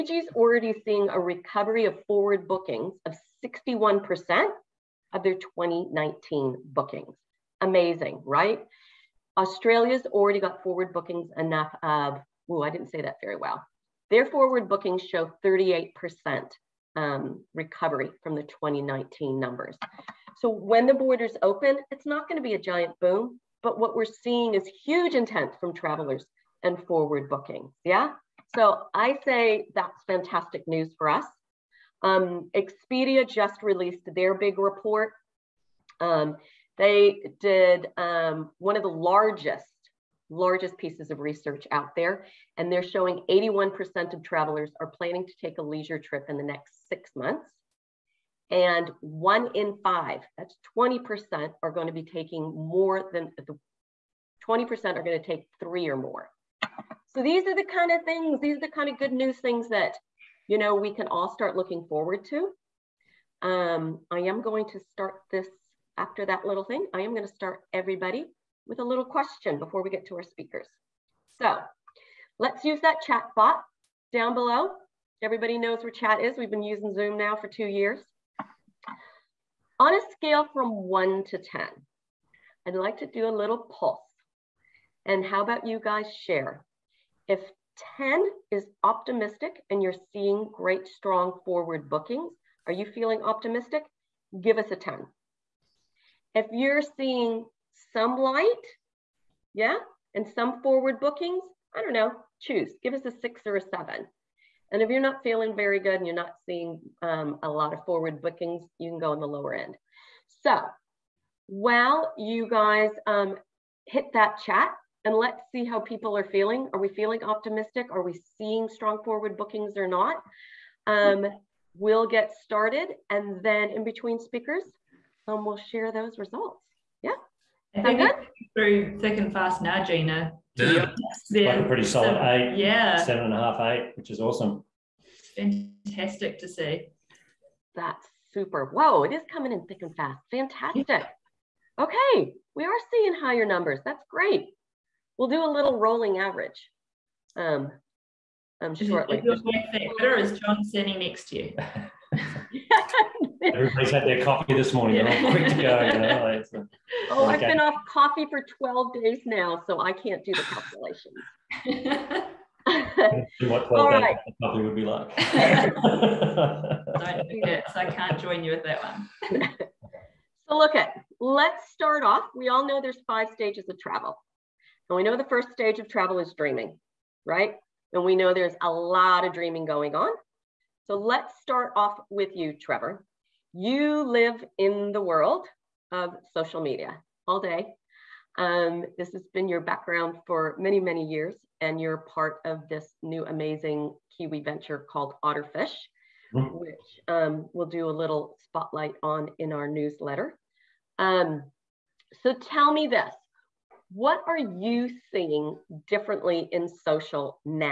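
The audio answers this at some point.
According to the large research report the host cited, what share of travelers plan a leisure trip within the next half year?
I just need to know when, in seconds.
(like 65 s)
43 s.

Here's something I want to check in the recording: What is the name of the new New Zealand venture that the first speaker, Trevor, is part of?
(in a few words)
Otterfish.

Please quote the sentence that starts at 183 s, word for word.
You live in the world of social media all day.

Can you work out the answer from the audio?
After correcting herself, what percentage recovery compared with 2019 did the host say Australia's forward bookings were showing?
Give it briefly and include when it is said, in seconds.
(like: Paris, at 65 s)
38%, at 15 s.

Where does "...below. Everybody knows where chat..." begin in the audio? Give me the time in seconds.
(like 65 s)
74 s.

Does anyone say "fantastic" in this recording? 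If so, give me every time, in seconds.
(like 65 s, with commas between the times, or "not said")
30 s, 135 s, 140 s.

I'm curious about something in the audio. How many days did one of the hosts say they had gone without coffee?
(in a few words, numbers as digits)
12.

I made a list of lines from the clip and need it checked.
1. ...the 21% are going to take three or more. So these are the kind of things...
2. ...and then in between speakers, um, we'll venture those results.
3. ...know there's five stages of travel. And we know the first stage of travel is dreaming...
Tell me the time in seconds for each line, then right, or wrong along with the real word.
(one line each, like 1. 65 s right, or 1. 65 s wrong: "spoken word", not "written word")
1. 53 s wrong: "20", not "21"
2. 123 s wrong: "share", not "venture"
3. 172 s right.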